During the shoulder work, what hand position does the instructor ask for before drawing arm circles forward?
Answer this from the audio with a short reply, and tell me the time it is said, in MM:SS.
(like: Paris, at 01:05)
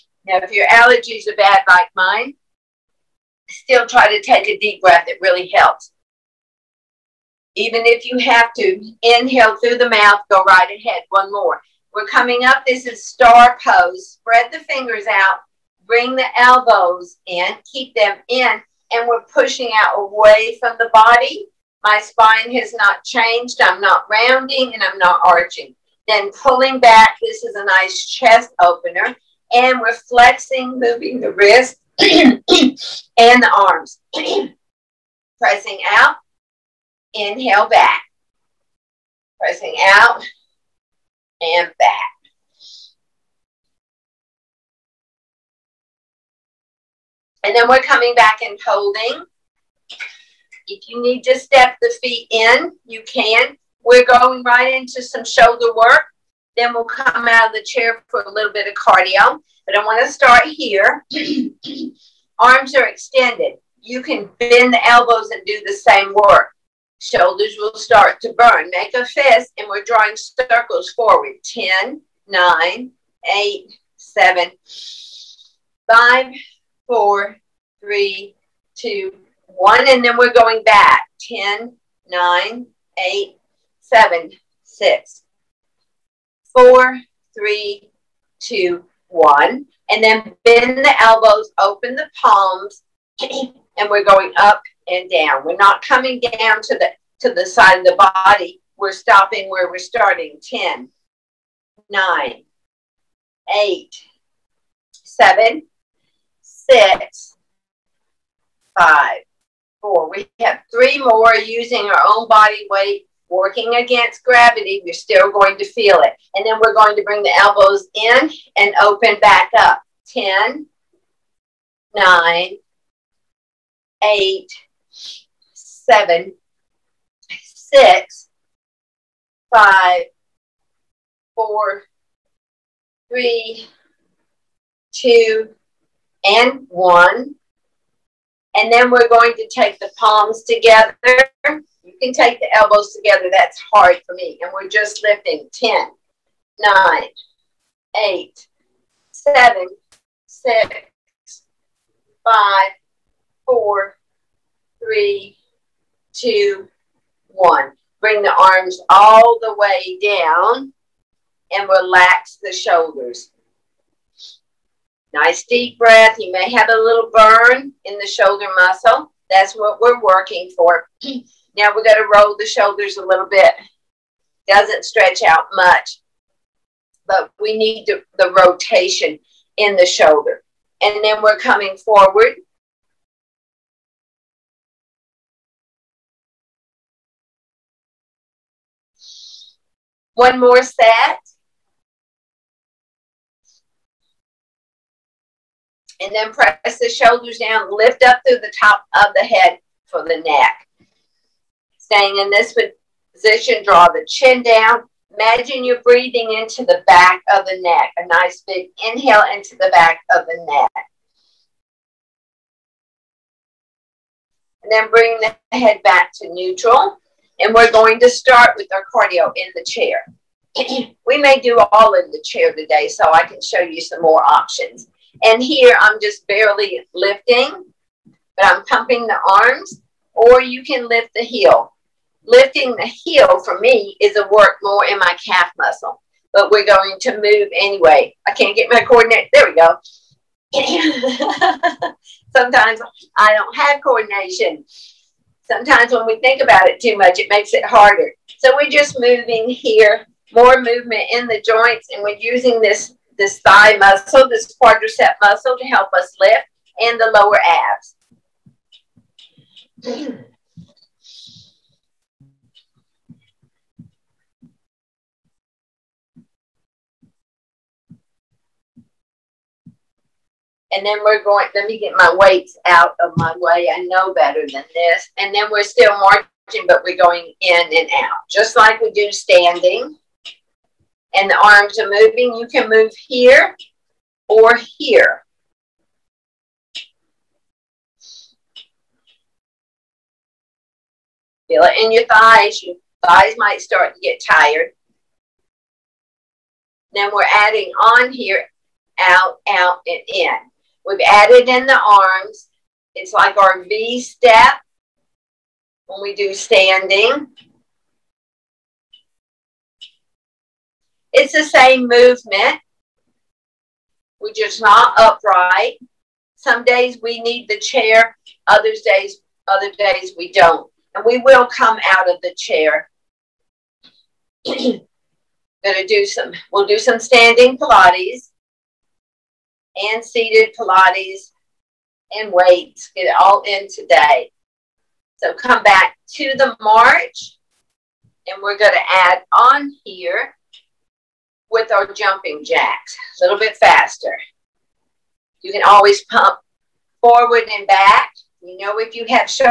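a fist, at 01:08.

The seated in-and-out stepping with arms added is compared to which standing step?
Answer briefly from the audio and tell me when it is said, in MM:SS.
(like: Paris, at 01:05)
V step, at 05:03.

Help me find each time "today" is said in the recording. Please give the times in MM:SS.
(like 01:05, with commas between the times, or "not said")
03:42, 05:33.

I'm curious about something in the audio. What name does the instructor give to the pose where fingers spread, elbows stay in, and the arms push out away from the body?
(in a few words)
star pose.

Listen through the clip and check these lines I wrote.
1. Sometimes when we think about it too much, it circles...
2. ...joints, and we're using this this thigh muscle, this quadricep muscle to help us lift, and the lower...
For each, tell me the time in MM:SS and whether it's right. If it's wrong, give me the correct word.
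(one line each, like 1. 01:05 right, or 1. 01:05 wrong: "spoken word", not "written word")
1. 04:05 wrong: "makes", not "circles"
2. 04:11 right.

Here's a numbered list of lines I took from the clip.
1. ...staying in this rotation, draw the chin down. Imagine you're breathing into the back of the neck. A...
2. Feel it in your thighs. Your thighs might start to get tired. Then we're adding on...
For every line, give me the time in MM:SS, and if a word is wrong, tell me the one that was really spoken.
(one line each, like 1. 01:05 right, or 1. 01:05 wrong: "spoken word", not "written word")
1. 03:21 wrong: "position", not "rotation"
2. 04:51 right.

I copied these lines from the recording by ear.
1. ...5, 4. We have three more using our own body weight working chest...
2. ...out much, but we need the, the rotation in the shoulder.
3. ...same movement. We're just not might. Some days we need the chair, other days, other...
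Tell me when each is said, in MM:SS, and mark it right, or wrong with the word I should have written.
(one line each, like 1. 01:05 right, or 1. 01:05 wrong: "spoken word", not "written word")
1. 01:48 wrong: "against", not "chest"
2. 02:55 right
3. 05:11 wrong: "upright", not "might".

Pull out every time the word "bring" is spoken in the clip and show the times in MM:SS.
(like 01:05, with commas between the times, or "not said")
00:15, 01:57, 02:38, 03:34.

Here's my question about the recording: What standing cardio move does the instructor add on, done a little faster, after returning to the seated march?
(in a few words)
jumping jacks.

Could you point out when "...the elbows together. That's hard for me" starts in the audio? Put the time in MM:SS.
02:22.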